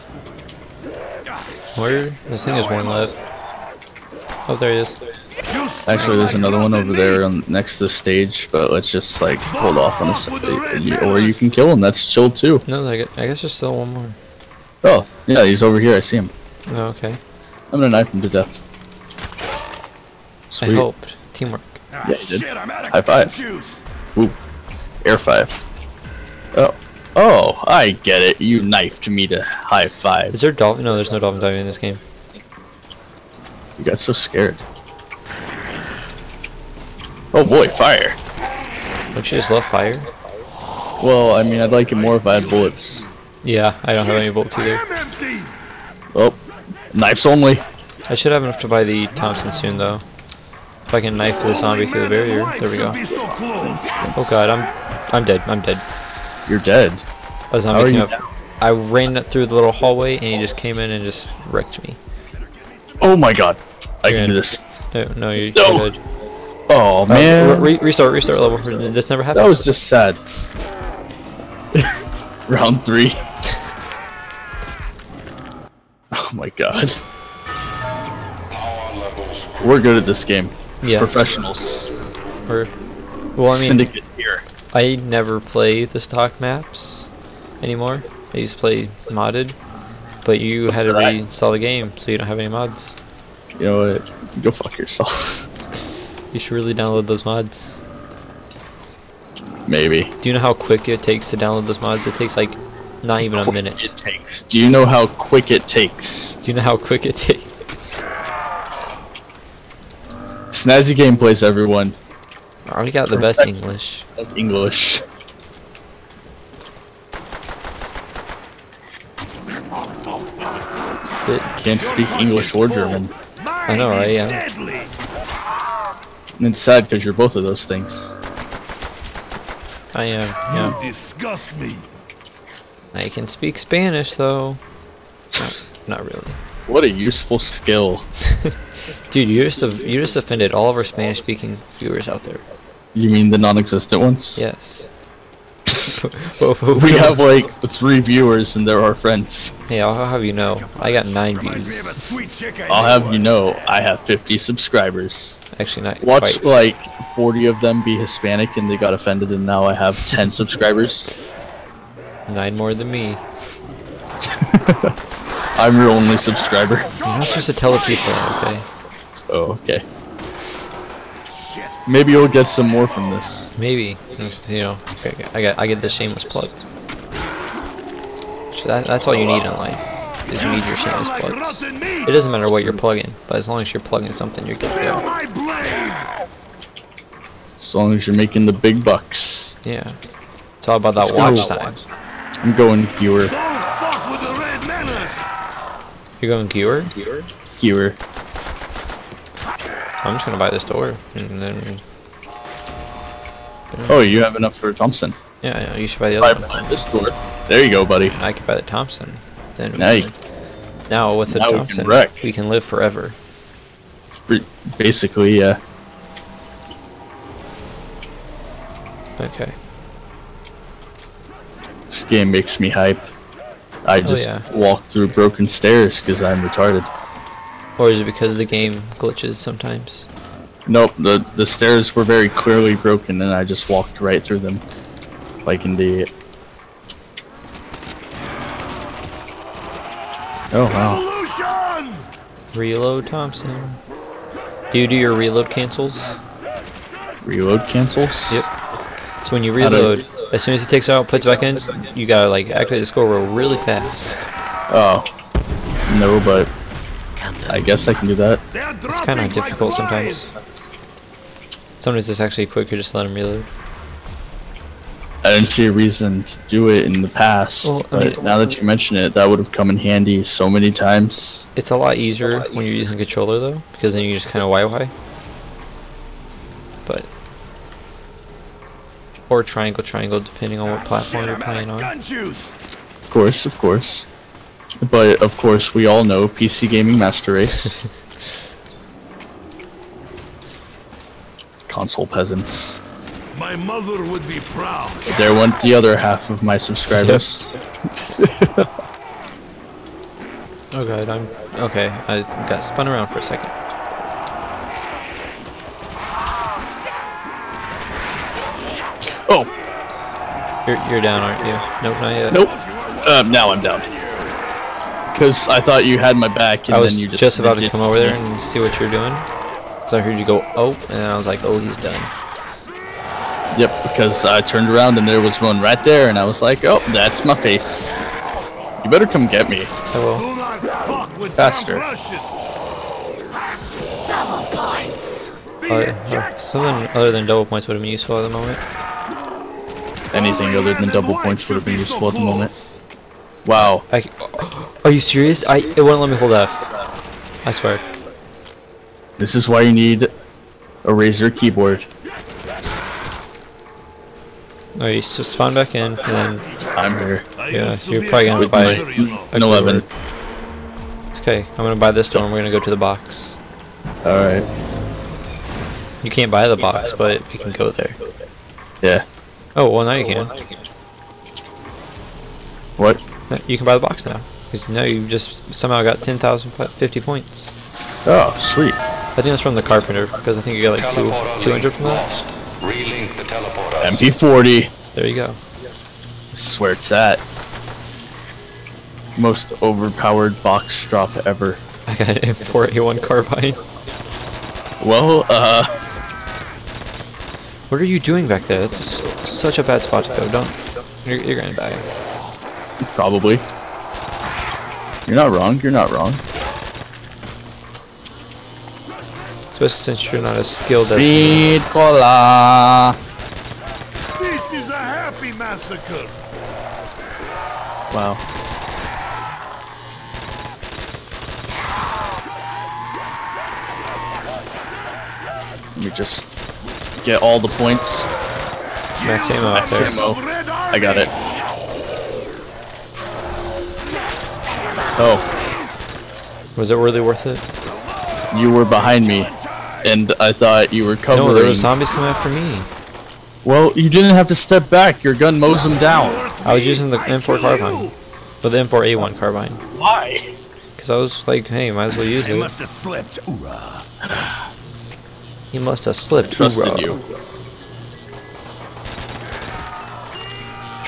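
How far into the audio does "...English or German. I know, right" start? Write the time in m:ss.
2:02.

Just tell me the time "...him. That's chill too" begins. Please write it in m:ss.
0:11.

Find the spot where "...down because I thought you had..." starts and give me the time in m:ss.
5:13.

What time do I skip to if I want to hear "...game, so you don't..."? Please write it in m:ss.
1:31.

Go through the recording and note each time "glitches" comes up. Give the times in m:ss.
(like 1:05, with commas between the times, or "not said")
3:48.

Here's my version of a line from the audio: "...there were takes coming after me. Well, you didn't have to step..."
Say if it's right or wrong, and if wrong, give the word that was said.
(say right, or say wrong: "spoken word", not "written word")
wrong: "zombies", not "takes".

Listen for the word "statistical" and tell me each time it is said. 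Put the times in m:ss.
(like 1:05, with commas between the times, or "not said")
not said.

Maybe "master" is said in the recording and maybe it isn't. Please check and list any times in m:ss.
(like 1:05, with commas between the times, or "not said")
4:46.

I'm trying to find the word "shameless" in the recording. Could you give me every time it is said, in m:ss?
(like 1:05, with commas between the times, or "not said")
2:55, 3:00.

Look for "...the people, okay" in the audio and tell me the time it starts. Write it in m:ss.
2:47.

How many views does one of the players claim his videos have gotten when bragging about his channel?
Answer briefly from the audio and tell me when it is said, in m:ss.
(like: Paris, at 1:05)
9, at 2:31.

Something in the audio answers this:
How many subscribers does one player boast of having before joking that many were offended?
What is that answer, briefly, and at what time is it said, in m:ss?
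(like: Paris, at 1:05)
50, at 2:34.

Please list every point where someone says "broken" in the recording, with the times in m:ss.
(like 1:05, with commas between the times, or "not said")
3:45, 3:52.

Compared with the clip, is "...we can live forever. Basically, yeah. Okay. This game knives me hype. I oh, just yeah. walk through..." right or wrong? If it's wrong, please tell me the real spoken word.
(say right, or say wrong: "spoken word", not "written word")
wrong: "makes", not "knives".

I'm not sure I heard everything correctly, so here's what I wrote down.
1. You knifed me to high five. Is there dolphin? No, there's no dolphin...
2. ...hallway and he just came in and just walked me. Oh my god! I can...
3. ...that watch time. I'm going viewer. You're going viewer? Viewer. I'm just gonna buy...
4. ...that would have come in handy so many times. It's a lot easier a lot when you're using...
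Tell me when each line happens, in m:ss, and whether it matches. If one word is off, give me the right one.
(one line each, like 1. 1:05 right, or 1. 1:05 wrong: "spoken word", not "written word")
1. 0:28 right
2. 0:59 wrong: "wrecked", not "walked"
3. 3:10 right
4. 4:29 right.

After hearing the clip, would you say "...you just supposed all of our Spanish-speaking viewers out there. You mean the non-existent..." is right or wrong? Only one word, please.
wrong.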